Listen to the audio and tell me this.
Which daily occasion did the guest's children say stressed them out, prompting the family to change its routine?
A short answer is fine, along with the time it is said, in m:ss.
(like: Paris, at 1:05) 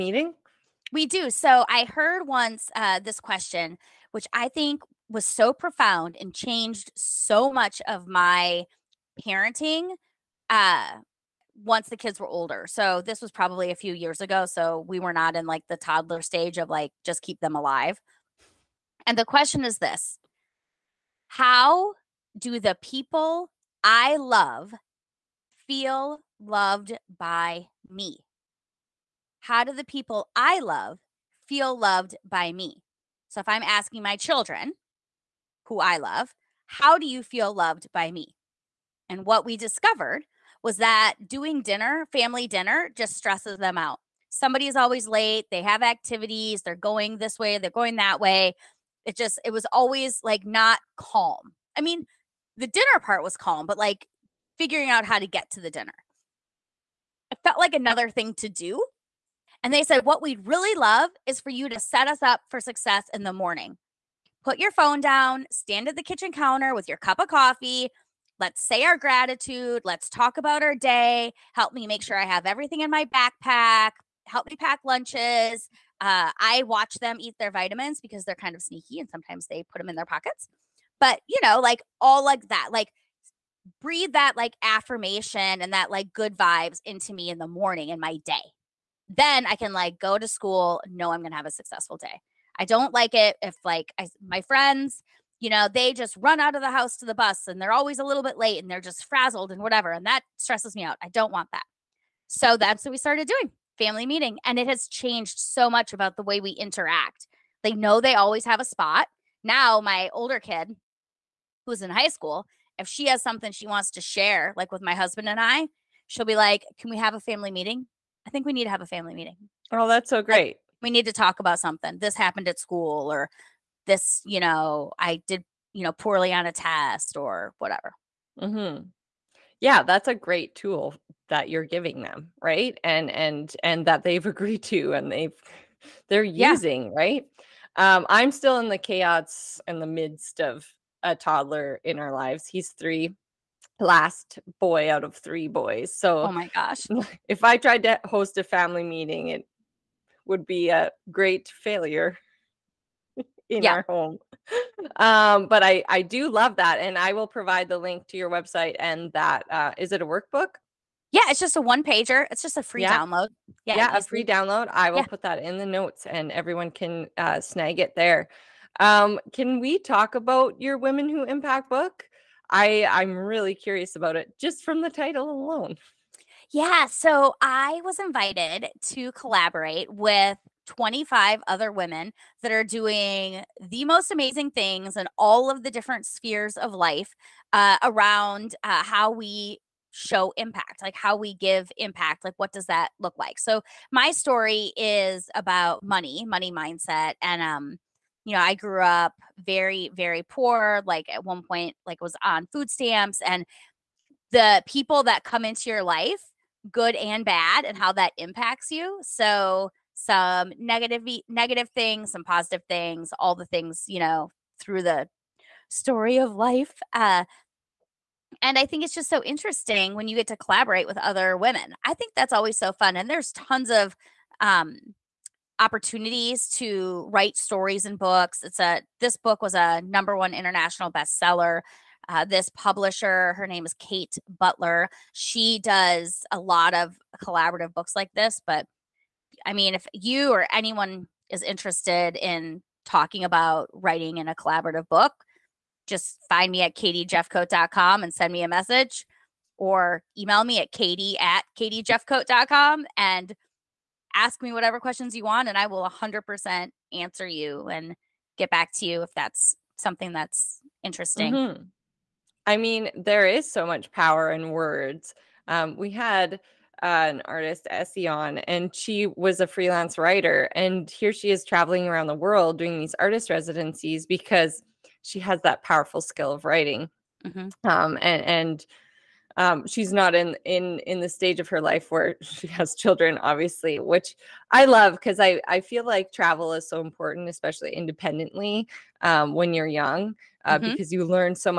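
Family dinner, at 0:42.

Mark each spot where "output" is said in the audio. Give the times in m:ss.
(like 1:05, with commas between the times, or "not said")
not said.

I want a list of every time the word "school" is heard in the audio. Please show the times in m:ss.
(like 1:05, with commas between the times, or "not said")
1:30, 1:52, 2:02.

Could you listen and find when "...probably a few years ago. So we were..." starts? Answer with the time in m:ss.
0:13.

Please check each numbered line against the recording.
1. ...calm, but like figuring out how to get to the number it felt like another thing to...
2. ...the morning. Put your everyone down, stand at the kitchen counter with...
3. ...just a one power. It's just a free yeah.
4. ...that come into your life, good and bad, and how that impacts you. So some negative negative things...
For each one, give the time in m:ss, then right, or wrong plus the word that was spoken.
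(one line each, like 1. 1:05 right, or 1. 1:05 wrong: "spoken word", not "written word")
1. 0:53 wrong: "dinner", not "number"
2. 1:03 wrong: "phone", not "everyone"
3. 2:41 wrong: "pager", not "power"
4. 3:25 right.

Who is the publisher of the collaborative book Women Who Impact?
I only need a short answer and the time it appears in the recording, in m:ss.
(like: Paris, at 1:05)
Kate Butler, at 3:53.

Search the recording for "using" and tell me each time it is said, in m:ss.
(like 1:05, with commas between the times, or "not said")
2:16.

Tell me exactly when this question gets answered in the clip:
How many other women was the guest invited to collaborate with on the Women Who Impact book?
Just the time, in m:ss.
3:00.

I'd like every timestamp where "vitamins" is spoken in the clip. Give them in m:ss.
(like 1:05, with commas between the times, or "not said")
1:17.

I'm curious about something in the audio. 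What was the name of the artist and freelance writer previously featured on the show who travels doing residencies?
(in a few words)
Essie.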